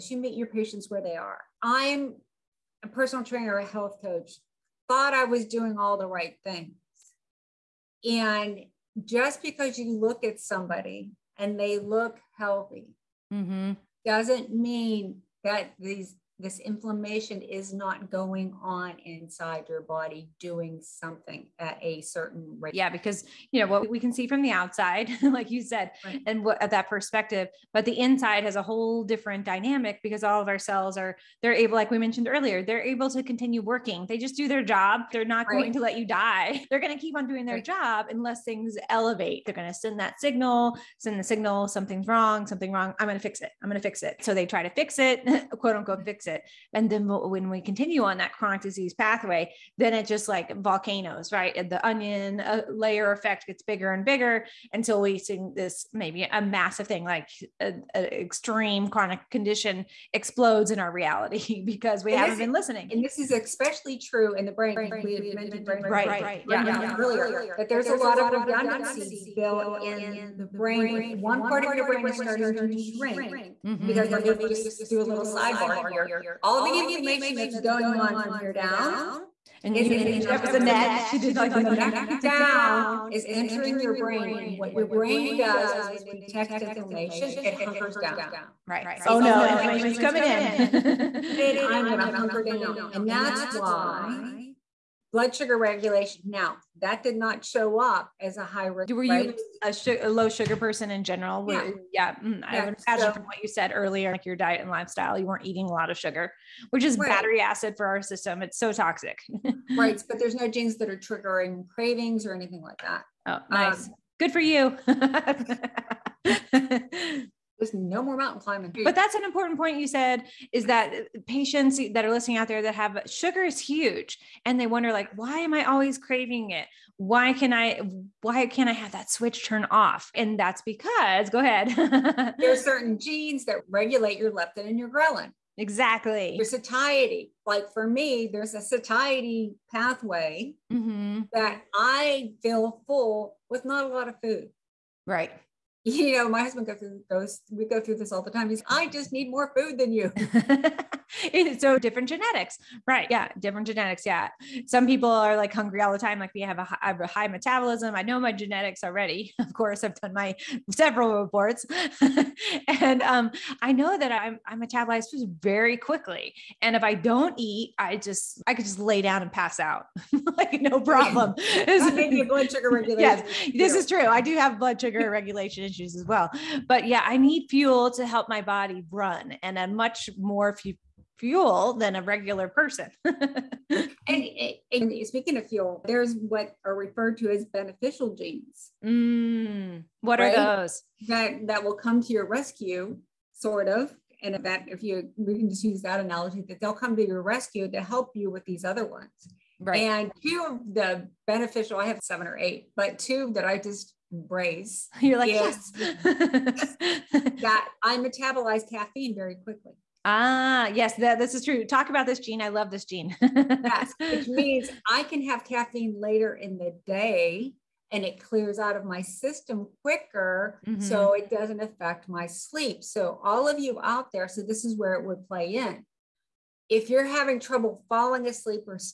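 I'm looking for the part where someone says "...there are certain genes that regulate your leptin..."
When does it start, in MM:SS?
02:12.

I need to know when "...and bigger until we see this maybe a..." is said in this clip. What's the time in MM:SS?
00:53.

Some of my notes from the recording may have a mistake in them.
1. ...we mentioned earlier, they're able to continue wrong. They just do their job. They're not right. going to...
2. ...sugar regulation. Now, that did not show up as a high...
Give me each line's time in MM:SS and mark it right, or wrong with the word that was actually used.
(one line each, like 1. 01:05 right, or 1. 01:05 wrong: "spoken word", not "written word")
1. 00:31 wrong: "working", not "wrong"
2. 01:35 right.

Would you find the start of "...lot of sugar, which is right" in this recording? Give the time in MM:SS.
01:45.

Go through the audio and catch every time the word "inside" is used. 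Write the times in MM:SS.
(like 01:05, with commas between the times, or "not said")
00:19, 00:27.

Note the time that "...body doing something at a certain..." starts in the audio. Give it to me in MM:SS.
00:19.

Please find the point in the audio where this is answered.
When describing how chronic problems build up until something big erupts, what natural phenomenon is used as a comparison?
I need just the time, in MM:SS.
00:50.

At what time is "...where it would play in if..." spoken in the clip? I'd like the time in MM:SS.
03:44.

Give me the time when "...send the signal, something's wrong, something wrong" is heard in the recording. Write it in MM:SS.
00:40.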